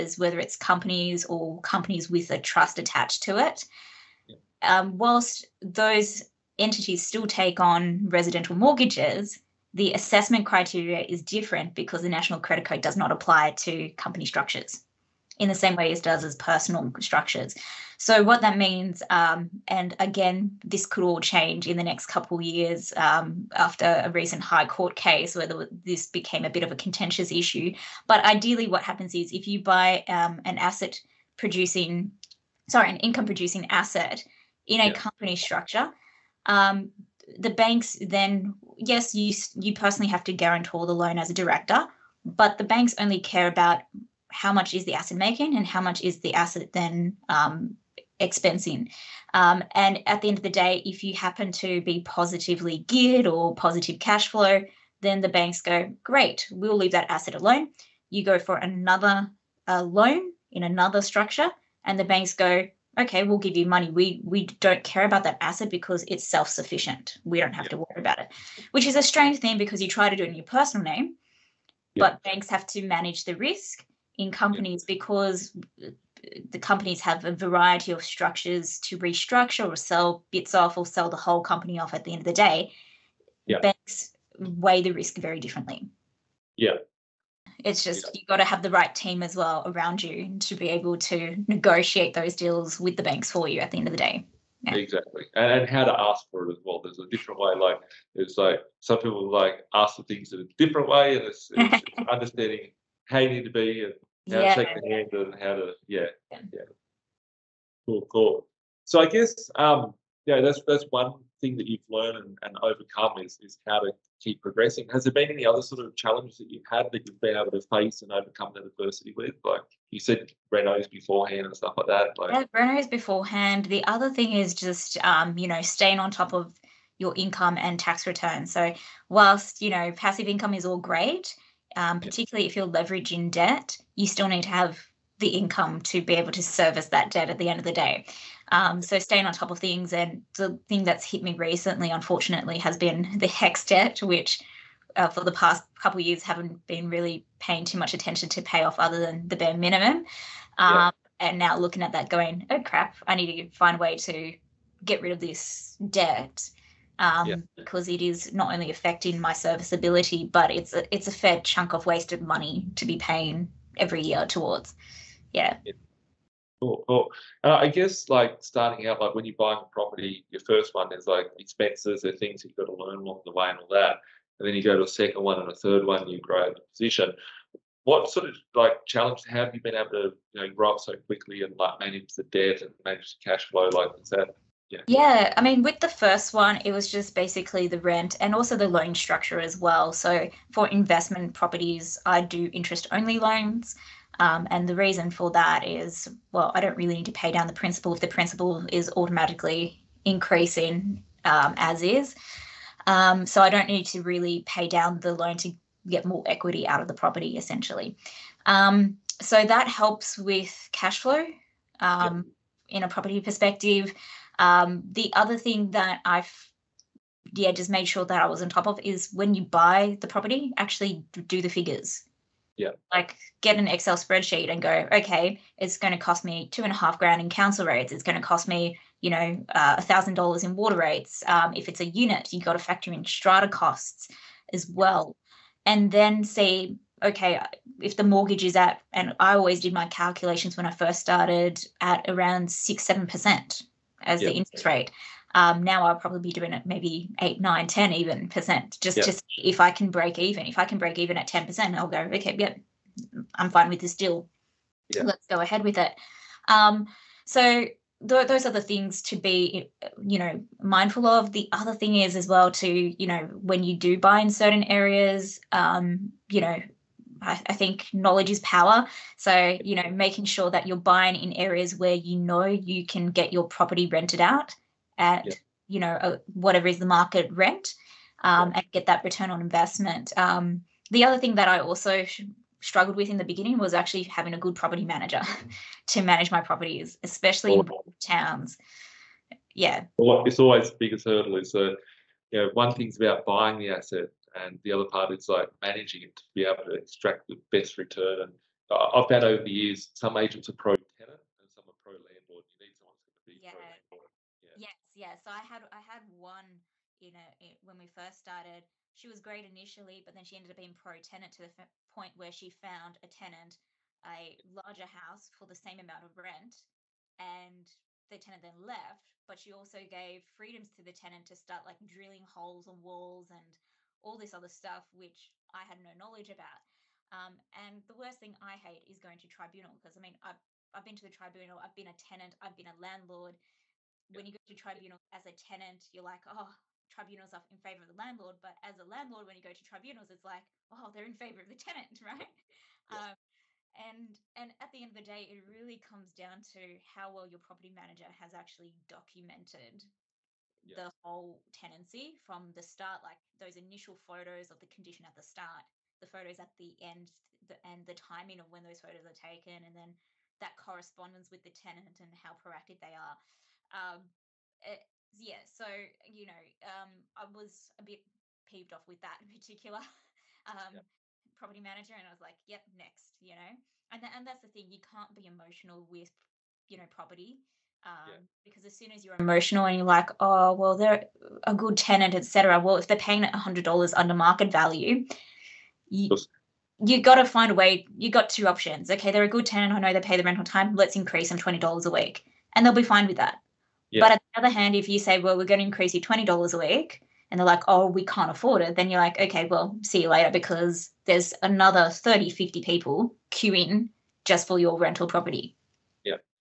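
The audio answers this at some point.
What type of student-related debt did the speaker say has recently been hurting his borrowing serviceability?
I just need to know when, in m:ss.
2:23.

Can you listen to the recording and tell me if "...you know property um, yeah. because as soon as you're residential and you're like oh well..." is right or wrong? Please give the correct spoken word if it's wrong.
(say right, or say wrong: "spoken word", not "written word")
wrong: "emotional", not "residential".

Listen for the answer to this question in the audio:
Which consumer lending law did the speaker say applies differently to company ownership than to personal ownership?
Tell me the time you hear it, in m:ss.
0:12.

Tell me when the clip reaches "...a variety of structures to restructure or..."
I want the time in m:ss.
1:17.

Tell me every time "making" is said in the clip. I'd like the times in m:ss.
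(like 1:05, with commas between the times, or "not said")
0:45, 4:29.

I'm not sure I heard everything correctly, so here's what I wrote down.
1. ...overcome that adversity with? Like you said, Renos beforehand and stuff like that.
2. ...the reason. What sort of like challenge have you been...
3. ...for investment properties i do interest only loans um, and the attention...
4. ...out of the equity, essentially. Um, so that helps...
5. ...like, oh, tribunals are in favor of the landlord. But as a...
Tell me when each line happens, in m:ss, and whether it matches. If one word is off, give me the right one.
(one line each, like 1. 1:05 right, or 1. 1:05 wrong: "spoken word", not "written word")
1. 1:58 right
2. 2:56 wrong: "position", not "reason"
3. 3:10 wrong: "reason", not "attention"
4. 3:26 wrong: "property", not "equity"
5. 5:36 right.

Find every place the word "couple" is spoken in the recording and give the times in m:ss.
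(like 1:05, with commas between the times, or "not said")
0:22, 2:25.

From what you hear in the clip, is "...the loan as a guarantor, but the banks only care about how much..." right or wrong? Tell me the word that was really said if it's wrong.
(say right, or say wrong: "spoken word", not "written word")
wrong: "director", not "guarantor".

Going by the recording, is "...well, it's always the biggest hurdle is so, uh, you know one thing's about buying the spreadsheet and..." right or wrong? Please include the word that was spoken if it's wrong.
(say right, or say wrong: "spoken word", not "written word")
wrong: "asset", not "spreadsheet".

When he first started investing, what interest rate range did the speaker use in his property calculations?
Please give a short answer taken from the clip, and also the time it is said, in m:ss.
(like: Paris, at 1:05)
6 to 7%, at 4:02.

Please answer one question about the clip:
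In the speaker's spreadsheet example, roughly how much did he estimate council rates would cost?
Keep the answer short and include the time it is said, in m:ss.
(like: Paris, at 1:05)
Two and a half grand, at 3:46.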